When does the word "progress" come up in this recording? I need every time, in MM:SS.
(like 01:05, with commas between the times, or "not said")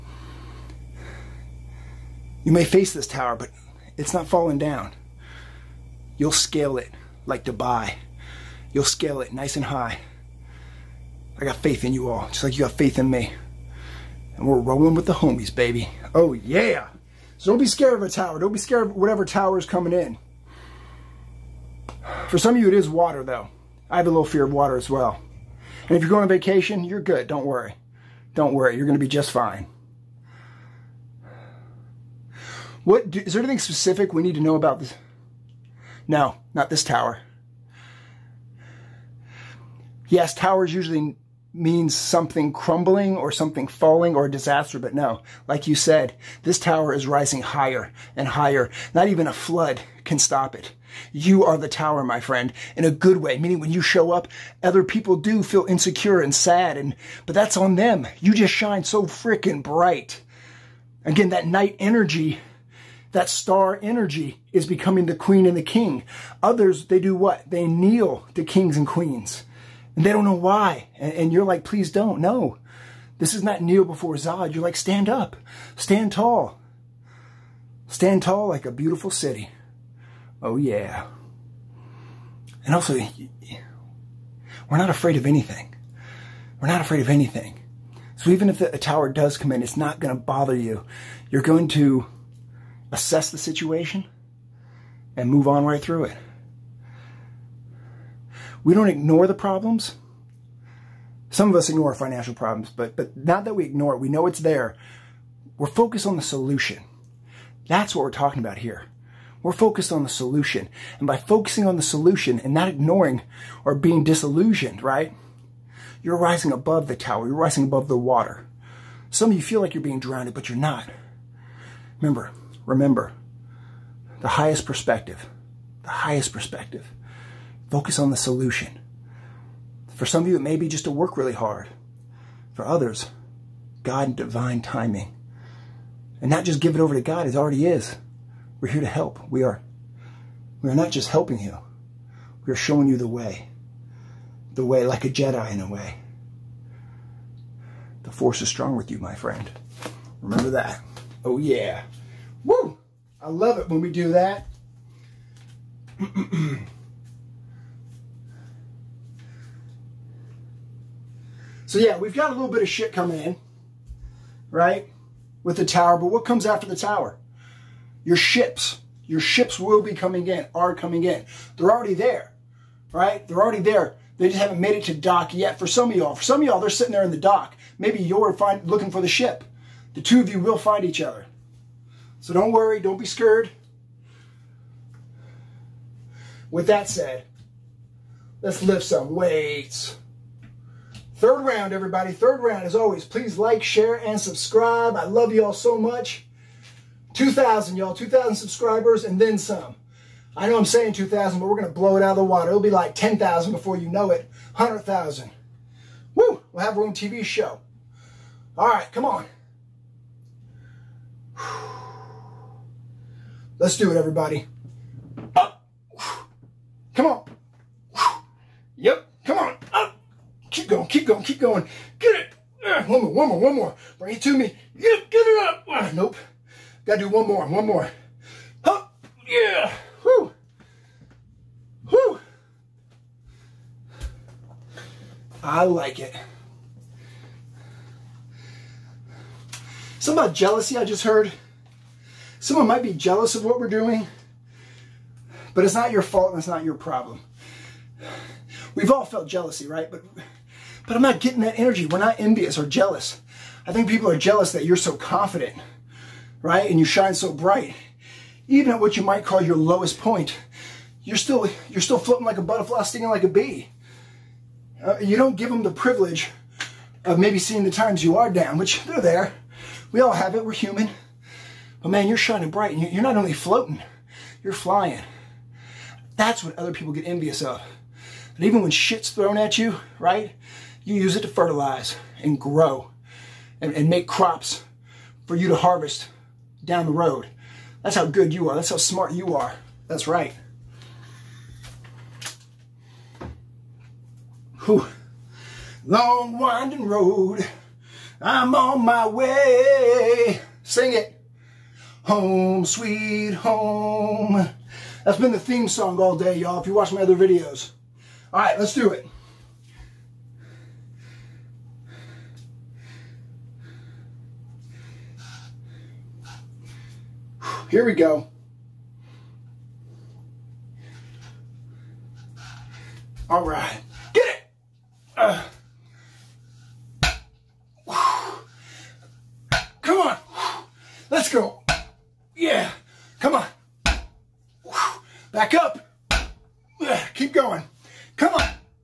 not said.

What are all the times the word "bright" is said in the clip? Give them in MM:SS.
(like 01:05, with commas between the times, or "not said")
00:59, 04:17, 04:32.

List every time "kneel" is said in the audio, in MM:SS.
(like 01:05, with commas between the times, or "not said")
01:07, 01:13.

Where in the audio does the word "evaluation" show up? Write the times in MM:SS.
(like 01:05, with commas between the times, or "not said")
not said.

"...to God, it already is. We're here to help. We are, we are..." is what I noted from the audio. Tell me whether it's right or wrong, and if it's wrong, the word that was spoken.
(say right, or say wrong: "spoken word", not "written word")
right.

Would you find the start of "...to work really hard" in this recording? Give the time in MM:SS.
02:10.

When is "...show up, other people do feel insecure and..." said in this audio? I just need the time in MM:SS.
00:53.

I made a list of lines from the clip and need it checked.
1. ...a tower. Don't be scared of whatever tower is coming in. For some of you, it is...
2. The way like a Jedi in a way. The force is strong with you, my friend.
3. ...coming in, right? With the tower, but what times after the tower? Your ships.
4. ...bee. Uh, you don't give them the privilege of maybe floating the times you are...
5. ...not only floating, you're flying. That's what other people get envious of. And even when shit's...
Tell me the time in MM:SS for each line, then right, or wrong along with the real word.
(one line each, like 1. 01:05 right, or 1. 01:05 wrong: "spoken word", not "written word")
1. 00:18 right
2. 02:24 right
3. 02:42 wrong: "comes", not "times"
4. 04:23 wrong: "seeing", not "floating"
5. 04:33 right.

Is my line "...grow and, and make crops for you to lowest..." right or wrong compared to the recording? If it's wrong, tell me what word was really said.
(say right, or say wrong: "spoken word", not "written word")
wrong: "harvest", not "lowest".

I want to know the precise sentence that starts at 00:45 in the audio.
Like you said, this tower is rising higher and higher.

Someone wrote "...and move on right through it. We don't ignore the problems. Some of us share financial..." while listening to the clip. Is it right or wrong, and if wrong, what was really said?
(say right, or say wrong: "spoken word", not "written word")
wrong: "ignore", not "share".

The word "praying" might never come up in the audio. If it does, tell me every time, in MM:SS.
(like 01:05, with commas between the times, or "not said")
not said.